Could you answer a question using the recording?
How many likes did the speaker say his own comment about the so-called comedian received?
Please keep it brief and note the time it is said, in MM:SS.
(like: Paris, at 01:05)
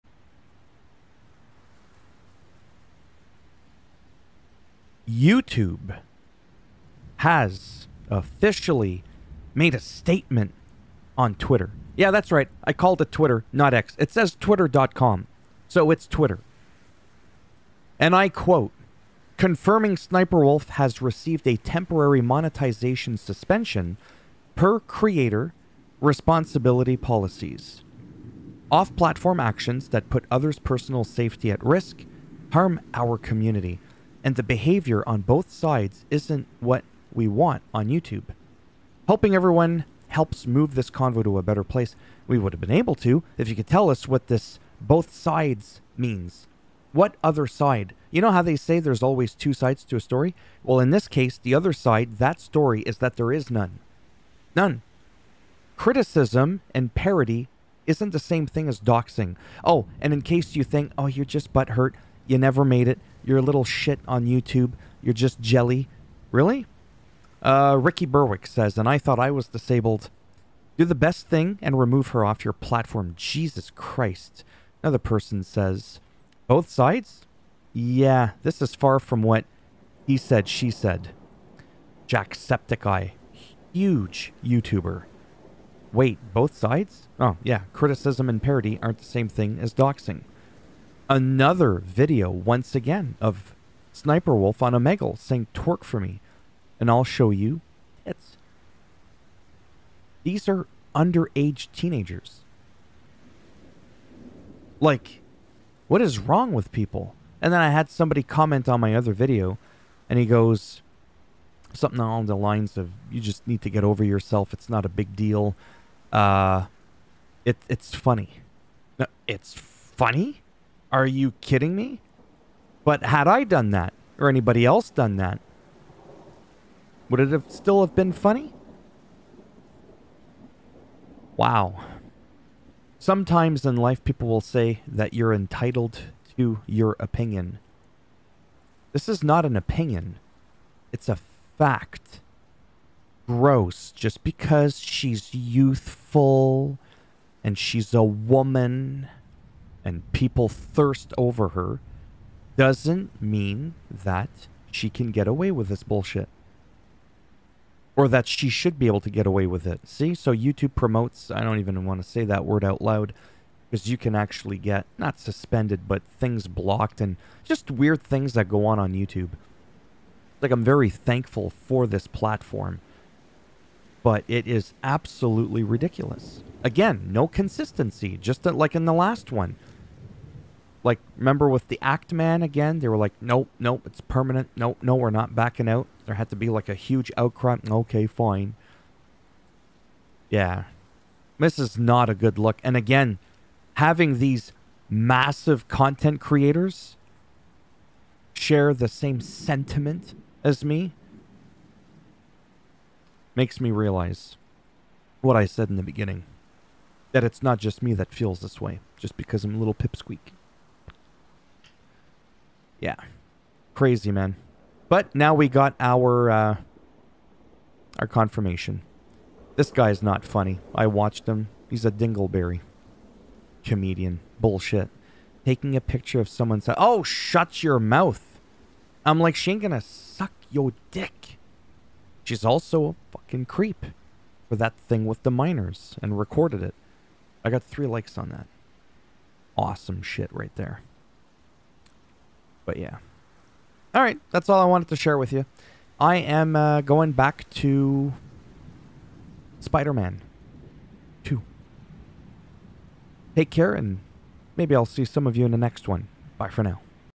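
3, at 03:57.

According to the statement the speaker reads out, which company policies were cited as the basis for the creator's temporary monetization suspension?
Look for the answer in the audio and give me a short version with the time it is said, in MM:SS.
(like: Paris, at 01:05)
Creator responsibility policies, at 00:24.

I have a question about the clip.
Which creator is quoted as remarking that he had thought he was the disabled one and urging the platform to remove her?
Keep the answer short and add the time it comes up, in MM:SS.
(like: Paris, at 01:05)
Ricky Berwick, at 01:07.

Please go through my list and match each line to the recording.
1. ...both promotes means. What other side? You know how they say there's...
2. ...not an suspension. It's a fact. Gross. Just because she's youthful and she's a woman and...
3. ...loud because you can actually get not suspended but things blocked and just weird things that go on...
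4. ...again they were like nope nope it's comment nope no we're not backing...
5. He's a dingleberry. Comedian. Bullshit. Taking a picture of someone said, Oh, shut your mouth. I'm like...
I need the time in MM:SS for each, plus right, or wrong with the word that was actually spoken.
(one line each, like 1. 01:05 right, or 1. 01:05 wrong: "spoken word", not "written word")
1. 00:44 wrong: "sides", not "promotes"
2. 02:19 wrong: "opinion", not "suspension"
3. 02:42 right
4. 03:02 wrong: "permanent", not "comment"
5. 03:41 right.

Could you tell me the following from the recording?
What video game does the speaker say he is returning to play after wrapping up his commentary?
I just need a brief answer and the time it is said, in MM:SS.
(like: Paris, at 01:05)
Spider-Man 2, at 04:09.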